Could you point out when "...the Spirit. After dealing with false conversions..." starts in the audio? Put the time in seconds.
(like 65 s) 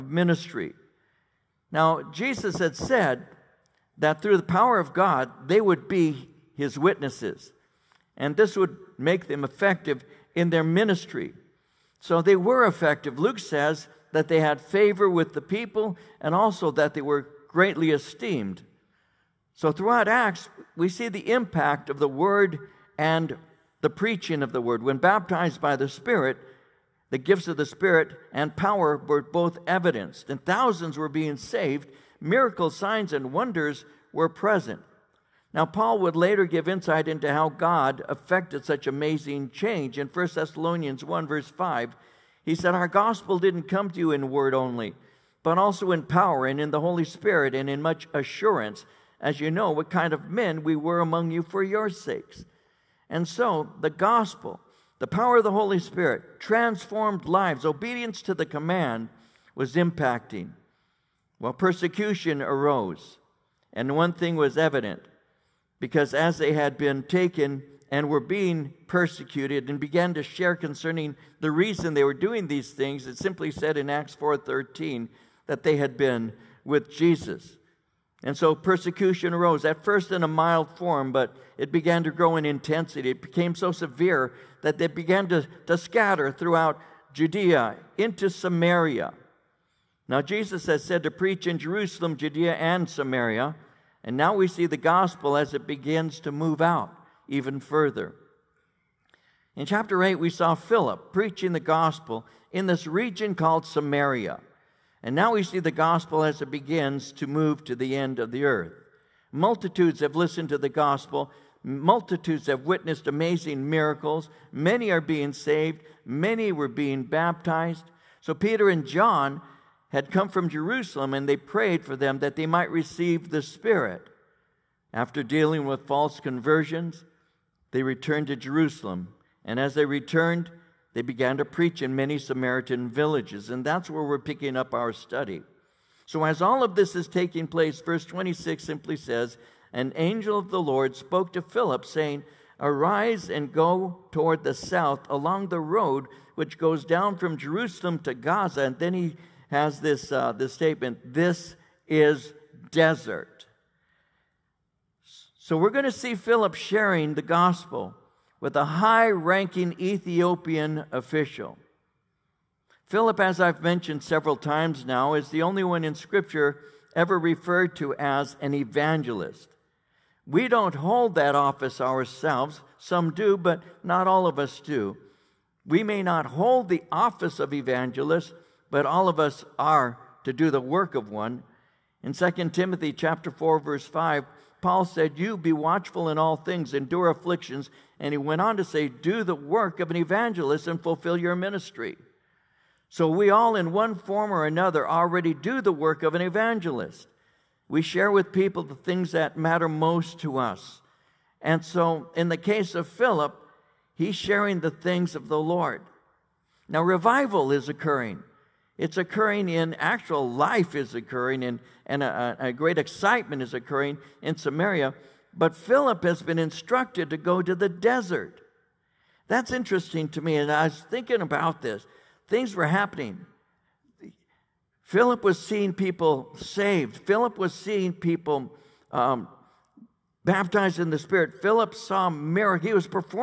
123 s.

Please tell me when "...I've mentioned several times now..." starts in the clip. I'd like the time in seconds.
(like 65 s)
163 s.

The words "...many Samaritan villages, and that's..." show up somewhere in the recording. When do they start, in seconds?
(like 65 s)
131 s.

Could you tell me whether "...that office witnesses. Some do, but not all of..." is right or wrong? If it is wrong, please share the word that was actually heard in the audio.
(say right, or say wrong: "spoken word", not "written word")
wrong: "ourselves", not "witnesses".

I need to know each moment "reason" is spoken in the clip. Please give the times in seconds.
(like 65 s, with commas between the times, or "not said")
71 s.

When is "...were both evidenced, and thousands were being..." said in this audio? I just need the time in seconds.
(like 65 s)
28 s.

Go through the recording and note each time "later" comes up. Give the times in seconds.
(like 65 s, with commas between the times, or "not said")
36 s.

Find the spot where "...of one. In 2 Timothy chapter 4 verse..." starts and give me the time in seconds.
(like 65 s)
180 s.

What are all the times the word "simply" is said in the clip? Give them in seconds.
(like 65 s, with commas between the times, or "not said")
73 s, 138 s.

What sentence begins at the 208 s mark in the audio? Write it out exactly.
It's occurring in actual life is occurring and, and a, a great excitement is occurring in Samaria.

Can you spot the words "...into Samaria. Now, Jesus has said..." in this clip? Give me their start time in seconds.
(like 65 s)
87 s.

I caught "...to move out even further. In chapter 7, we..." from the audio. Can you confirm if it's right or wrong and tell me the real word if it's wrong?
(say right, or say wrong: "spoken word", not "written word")
wrong: "8", not "7".